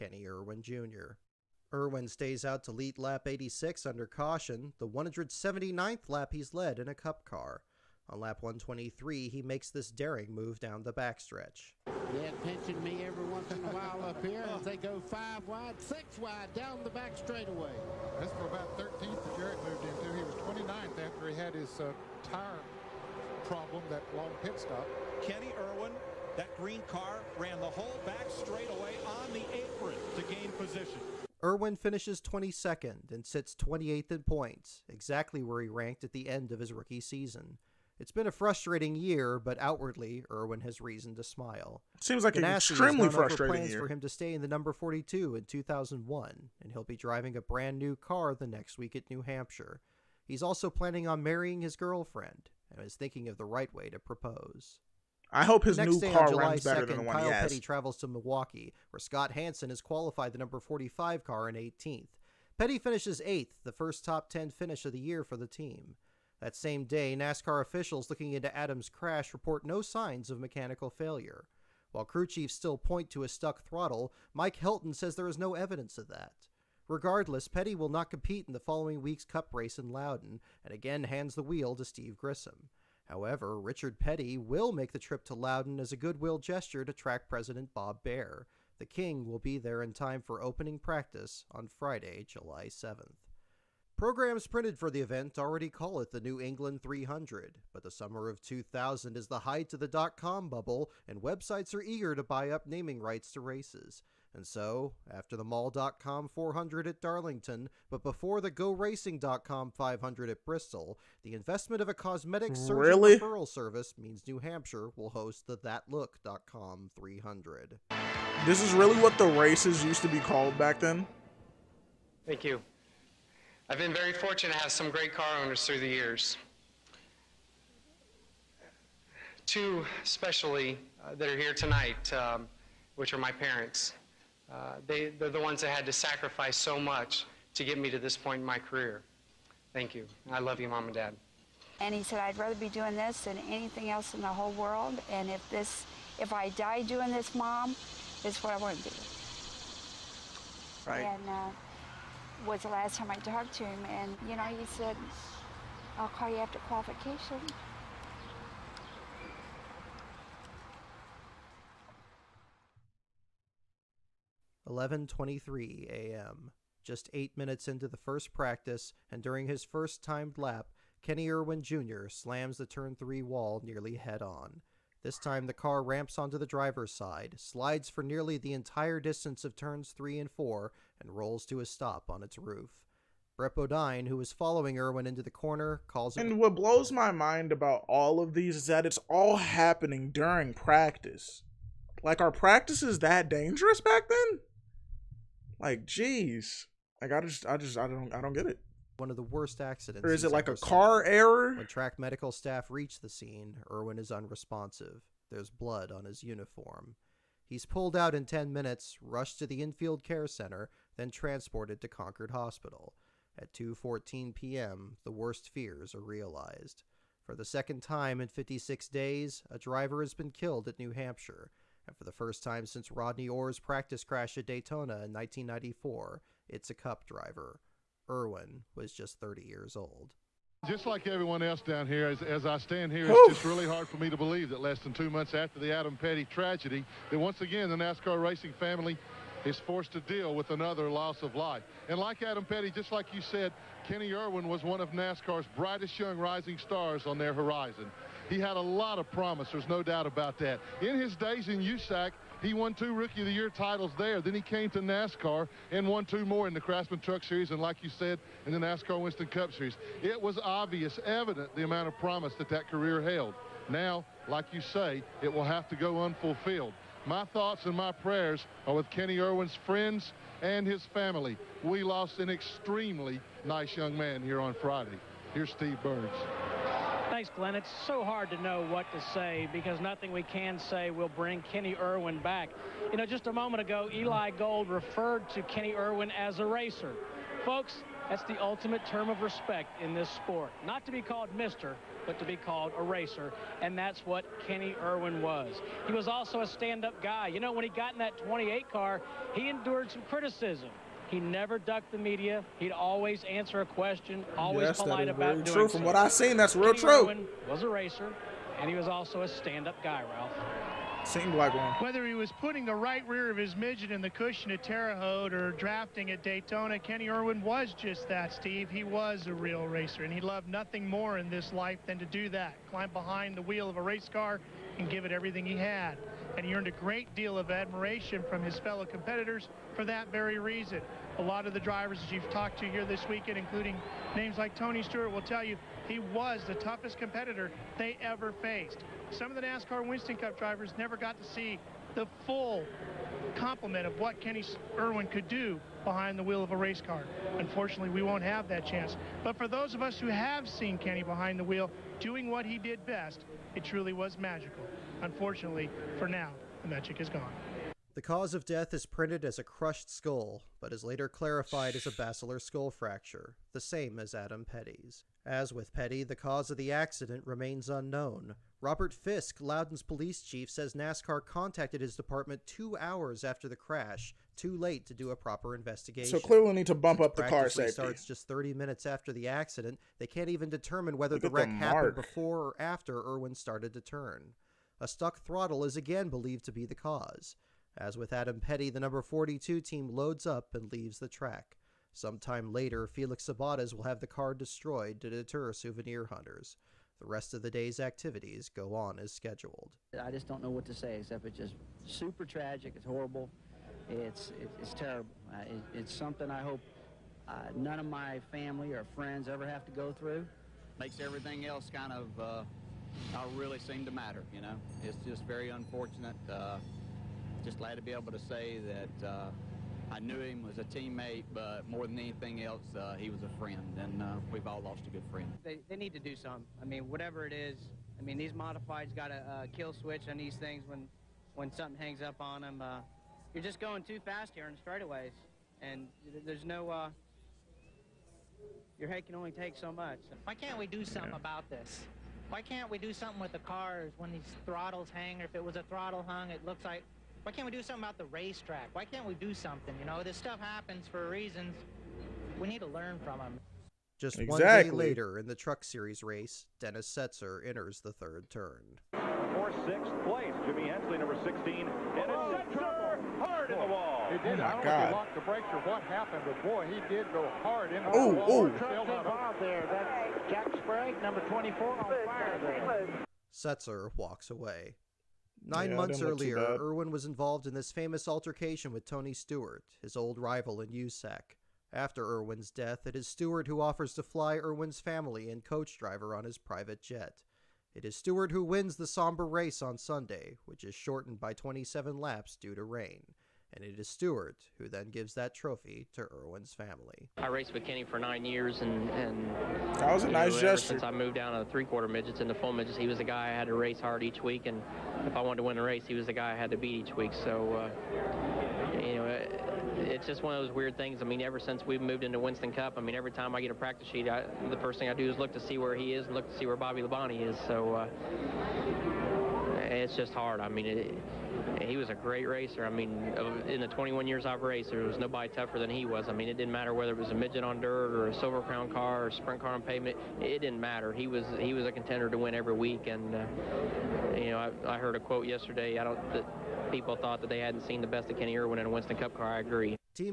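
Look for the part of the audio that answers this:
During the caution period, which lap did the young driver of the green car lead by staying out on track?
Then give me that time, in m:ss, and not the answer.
0:02.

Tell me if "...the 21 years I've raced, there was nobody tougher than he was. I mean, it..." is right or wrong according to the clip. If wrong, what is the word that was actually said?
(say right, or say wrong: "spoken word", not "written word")
right.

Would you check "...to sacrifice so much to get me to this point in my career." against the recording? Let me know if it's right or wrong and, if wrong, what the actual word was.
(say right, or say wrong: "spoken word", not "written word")
right.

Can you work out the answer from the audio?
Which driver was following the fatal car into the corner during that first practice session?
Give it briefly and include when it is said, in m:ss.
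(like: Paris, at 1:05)
Brett Bodine, at 3:03.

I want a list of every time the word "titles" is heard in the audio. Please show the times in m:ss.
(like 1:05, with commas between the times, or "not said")
4:13.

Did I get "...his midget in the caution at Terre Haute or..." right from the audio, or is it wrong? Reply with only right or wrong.
wrong.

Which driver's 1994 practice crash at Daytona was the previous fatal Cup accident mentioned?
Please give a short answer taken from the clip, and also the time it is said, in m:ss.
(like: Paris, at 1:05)
Rodney Orr, at 3:42.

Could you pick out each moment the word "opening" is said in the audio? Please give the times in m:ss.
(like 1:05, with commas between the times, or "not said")
1:30.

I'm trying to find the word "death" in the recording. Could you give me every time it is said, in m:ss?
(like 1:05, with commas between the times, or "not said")
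5:58, 8:02.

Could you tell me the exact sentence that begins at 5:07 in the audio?
Irwin was a racer, and he was also a stand-up guy, Ralph.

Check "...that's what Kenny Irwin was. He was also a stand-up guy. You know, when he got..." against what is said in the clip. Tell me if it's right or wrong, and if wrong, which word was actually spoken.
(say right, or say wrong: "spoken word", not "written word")
right.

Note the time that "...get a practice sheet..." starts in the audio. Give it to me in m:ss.
8:33.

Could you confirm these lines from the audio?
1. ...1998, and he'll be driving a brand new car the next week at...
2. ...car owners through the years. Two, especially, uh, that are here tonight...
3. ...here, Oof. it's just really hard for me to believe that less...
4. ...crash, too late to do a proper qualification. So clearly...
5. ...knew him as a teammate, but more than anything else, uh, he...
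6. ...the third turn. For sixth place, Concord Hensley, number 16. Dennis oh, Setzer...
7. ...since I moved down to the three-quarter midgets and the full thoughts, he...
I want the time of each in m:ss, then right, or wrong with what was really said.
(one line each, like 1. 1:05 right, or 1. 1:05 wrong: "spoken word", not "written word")
1. 0:45 wrong: "2001", not "1998"
2. 2:05 right
3. 3:52 right
4. 6:13 wrong: "investigation", not "qualification"
5. 6:59 right
6. 7:37 wrong: "Jimmy", not "Concord"
7. 8:20 wrong: "midgets", not "thoughts".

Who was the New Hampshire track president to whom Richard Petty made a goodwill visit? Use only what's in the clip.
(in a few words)
Bob Bahre.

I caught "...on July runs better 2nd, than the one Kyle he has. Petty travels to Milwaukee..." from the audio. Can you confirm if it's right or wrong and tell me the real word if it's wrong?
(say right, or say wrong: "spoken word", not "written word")
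right.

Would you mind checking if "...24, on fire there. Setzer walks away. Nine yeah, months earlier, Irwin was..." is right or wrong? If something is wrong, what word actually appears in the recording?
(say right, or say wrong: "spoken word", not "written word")
right.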